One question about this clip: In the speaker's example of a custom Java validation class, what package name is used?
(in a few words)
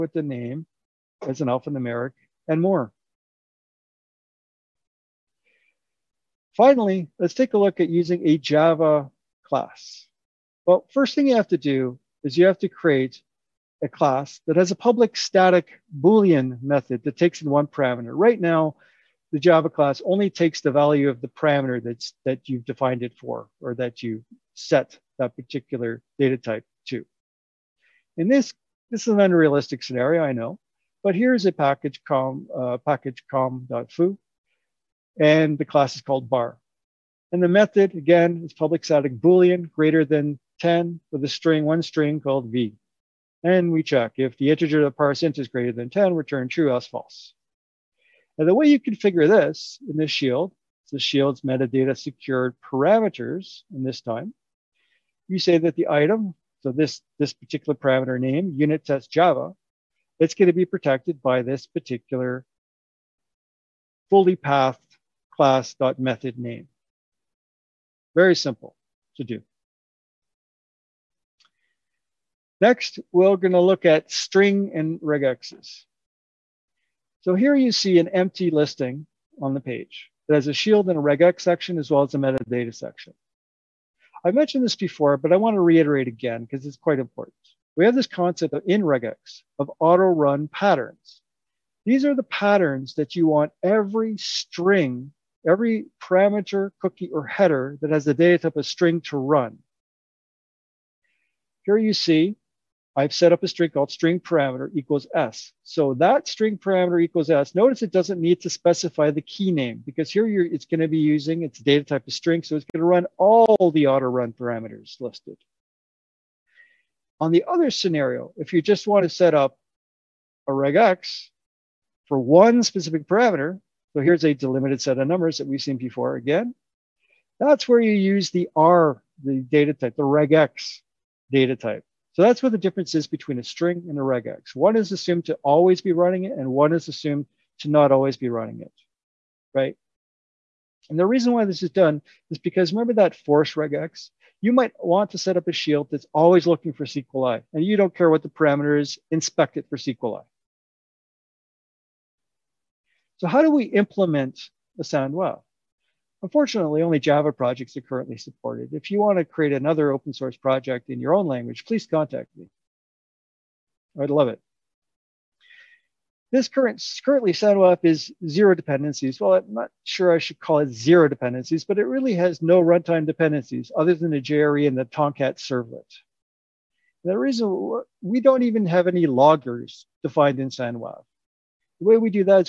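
com.foo.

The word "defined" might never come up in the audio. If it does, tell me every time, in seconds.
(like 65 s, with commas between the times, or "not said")
22 s, 180 s.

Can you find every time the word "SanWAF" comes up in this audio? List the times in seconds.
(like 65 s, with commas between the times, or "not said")
154 s, 167 s, 180 s.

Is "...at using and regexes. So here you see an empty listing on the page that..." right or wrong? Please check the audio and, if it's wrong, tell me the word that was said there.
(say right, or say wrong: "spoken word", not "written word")
wrong: "string", not "using".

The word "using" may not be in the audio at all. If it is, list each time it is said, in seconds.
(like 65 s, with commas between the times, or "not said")
7 s, 110 s.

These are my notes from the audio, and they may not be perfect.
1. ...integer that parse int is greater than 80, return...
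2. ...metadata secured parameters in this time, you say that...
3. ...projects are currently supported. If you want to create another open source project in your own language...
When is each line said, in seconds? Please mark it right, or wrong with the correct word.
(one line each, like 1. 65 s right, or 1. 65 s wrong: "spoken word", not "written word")
1. 44 s wrong: "10", not "80"
2. 51 s right
3. 157 s right.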